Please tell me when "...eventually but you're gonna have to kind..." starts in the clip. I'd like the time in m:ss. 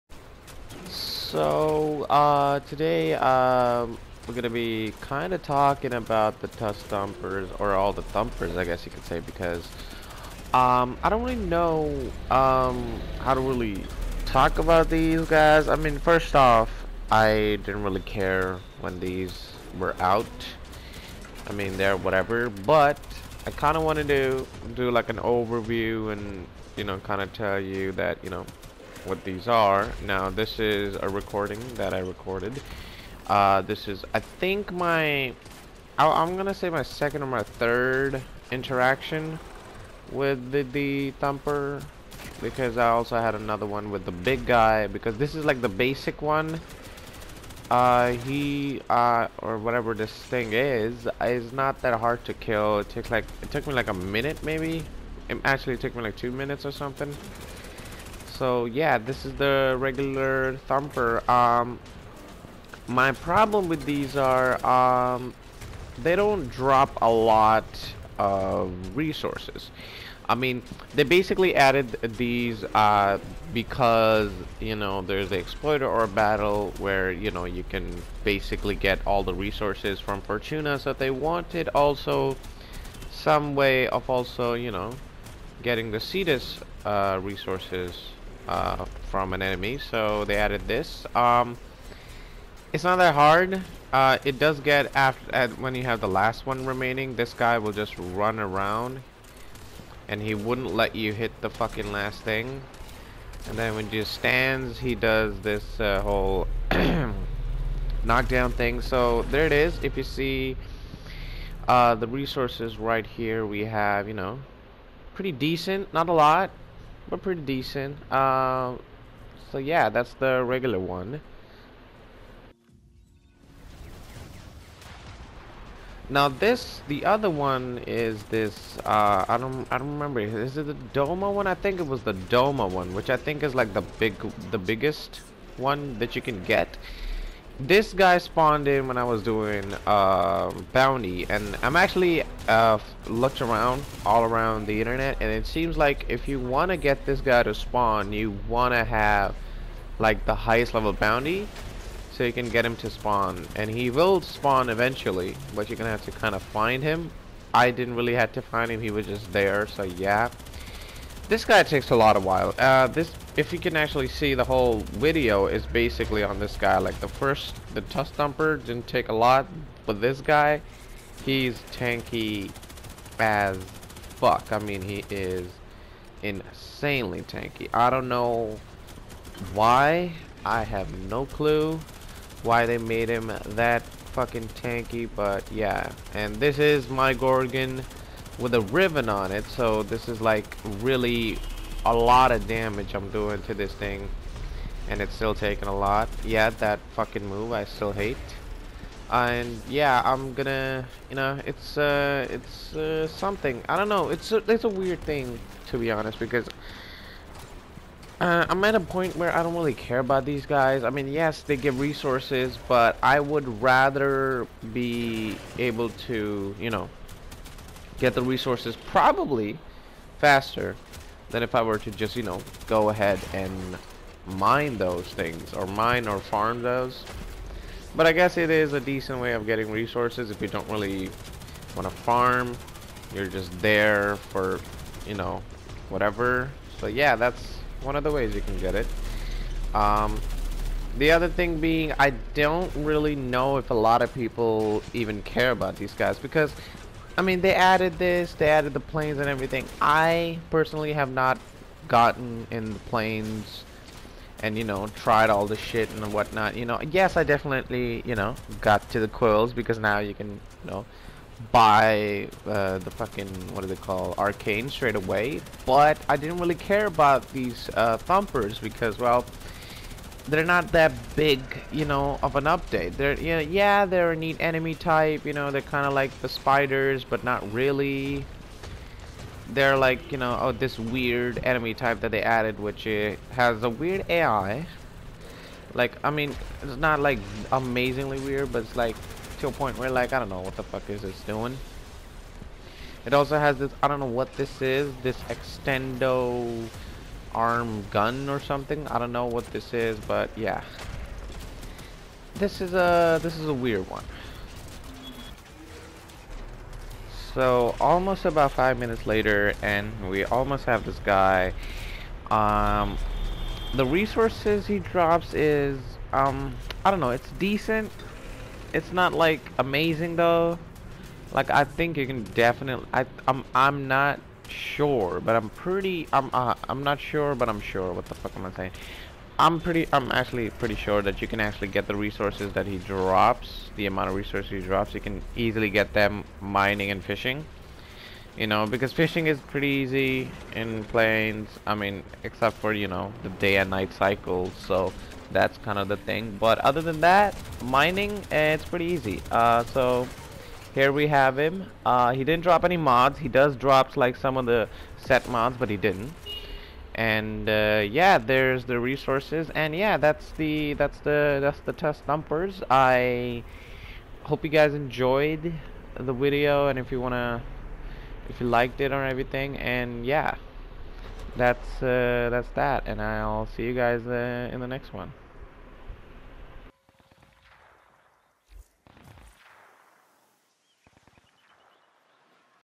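2:34.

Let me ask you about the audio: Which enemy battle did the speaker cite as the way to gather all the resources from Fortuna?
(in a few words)
Exploiter Orb.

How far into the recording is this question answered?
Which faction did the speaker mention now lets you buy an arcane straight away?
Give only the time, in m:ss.
4:19.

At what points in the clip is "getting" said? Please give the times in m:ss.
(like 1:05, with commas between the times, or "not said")
1:25, 3:49.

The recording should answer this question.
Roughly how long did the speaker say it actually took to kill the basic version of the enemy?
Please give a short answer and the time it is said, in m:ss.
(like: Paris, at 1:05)
2 minutes, at 0:56.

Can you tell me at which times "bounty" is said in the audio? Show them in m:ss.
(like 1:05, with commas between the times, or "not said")
2:20, 2:30.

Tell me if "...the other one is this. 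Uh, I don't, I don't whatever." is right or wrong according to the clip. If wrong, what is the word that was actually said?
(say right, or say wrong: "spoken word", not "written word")
wrong: "remember", not "whatever".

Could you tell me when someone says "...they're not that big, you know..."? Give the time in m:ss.
4:30.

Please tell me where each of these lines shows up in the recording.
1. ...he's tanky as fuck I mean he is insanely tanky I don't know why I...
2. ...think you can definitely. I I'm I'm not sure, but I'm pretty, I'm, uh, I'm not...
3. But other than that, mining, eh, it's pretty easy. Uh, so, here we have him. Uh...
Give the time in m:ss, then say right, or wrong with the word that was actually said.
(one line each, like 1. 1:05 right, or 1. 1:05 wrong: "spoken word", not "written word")
1. 2:51 right
2. 5:21 right
3. 5:46 right.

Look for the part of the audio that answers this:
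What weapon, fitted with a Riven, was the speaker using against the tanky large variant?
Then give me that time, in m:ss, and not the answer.
3:07.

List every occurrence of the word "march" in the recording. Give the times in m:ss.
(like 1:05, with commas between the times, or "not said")
not said.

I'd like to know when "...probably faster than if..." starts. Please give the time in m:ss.
3:38.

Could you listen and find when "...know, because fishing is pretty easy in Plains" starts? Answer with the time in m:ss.
5:38.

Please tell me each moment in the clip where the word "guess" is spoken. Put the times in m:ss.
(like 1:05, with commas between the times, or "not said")
0:08, 3:48.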